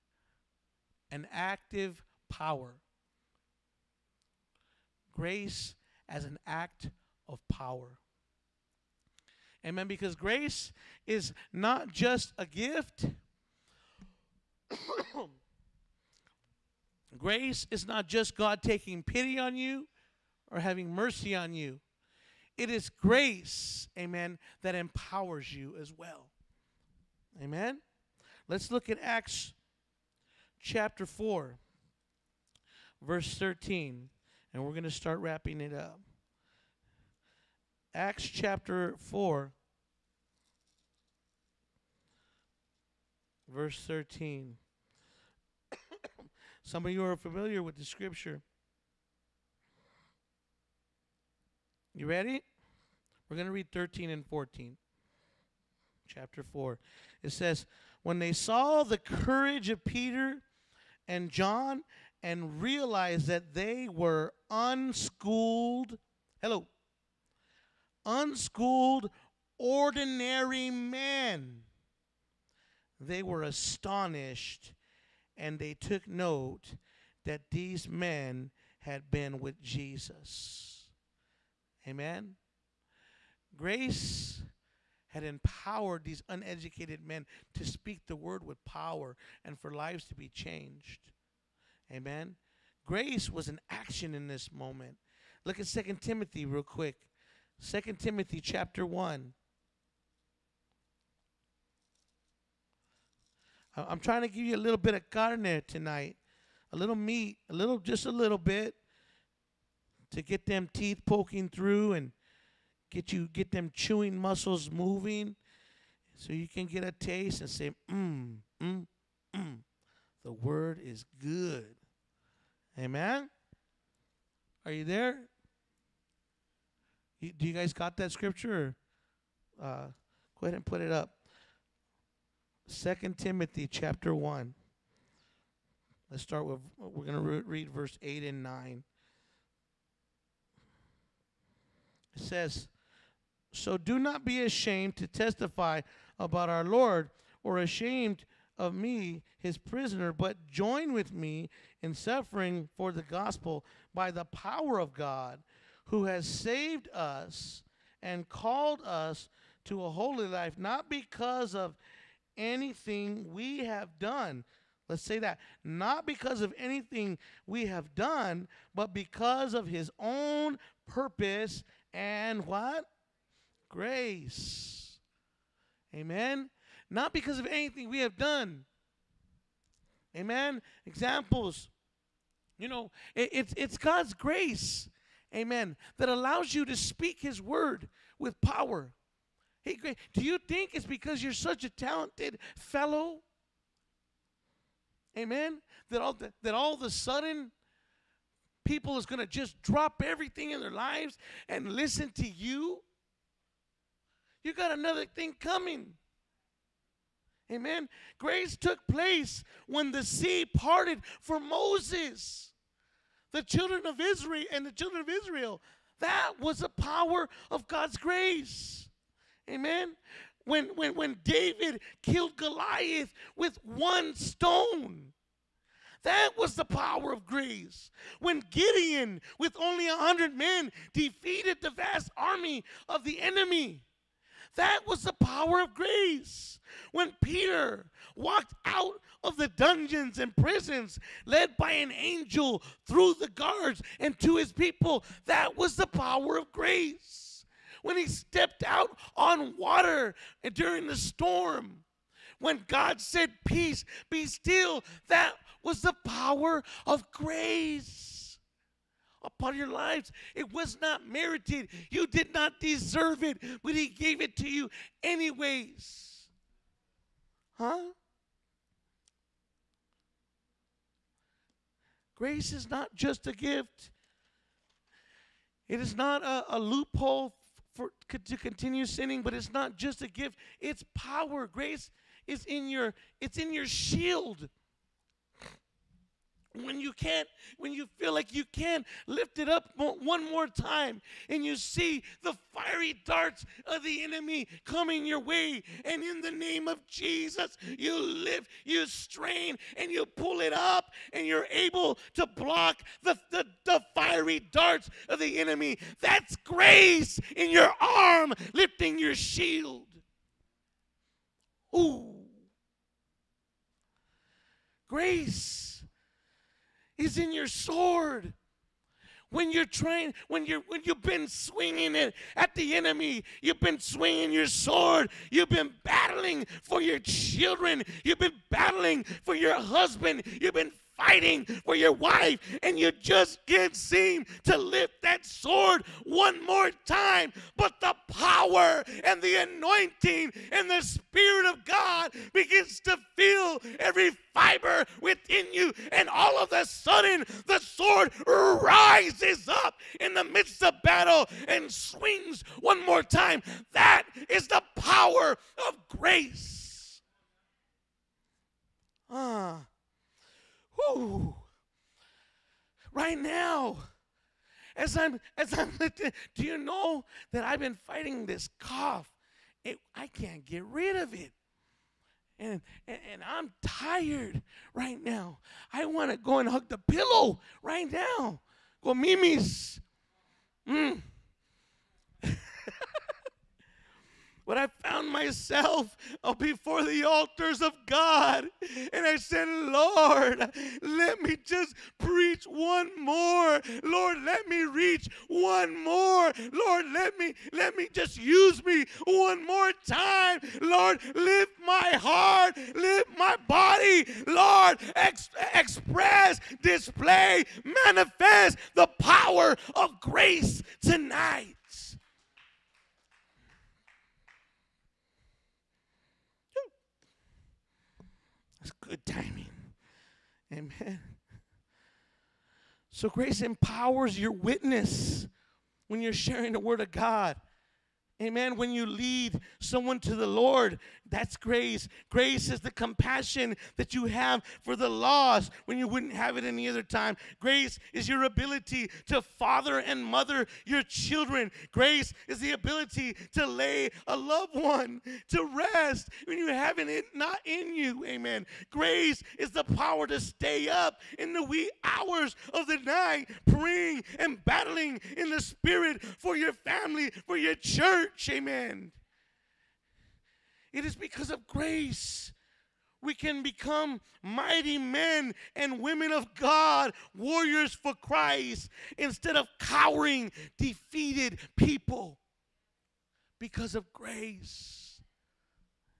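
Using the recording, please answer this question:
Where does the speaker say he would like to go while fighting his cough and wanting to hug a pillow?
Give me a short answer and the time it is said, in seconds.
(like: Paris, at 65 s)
Mimi's, at 378 s.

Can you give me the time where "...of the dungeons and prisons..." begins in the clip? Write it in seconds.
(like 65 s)
239 s.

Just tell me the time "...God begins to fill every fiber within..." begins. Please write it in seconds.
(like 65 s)
341 s.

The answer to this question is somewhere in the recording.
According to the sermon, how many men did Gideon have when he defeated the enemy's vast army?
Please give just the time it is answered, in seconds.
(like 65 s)
229 s.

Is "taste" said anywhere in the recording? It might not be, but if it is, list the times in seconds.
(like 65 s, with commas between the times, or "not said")
116 s.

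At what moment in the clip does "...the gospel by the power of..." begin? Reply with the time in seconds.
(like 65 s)
152 s.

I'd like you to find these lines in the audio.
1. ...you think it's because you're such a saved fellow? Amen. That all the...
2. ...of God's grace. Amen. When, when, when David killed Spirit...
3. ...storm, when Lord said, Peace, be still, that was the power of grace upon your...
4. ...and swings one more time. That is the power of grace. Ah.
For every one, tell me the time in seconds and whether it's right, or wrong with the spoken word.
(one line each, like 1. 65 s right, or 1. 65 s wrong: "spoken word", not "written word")
1. 190 s wrong: "talented", not "saved"
2. 217 s wrong: "Goliath", not "Spirit"
3. 250 s wrong: "God", not "Lord"
4. 351 s right.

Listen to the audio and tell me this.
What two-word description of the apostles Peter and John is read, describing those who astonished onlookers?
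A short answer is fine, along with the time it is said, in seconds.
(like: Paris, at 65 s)
ordinary men, at 69 s.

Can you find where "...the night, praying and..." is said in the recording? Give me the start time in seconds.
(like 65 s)
452 s.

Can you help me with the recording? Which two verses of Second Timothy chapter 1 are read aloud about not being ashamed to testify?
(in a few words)
8 and 9.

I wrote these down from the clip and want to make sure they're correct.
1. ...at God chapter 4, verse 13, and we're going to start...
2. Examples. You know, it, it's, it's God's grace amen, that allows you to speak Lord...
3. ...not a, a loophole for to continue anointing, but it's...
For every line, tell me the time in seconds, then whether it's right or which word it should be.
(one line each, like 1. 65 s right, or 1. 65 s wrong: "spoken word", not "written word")
1. 28 s wrong: "Acts", not "God"
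2. 180 s wrong: "His", not "Lord"
3. 275 s wrong: "sinning", not "anointing".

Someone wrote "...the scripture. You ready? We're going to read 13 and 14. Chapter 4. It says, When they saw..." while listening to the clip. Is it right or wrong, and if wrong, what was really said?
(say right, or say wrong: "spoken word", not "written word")
right.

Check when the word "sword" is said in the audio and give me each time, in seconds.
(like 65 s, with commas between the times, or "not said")
317 s, 324 s, 335 s, 347 s.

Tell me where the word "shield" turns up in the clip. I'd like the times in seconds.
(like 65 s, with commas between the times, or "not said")
283 s, 309 s.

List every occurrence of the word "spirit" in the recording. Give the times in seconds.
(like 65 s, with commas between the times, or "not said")
340 s, 455 s.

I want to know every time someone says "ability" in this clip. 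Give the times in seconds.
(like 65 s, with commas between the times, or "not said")
438 s, 442 s.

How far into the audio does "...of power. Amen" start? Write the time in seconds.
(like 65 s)
7 s.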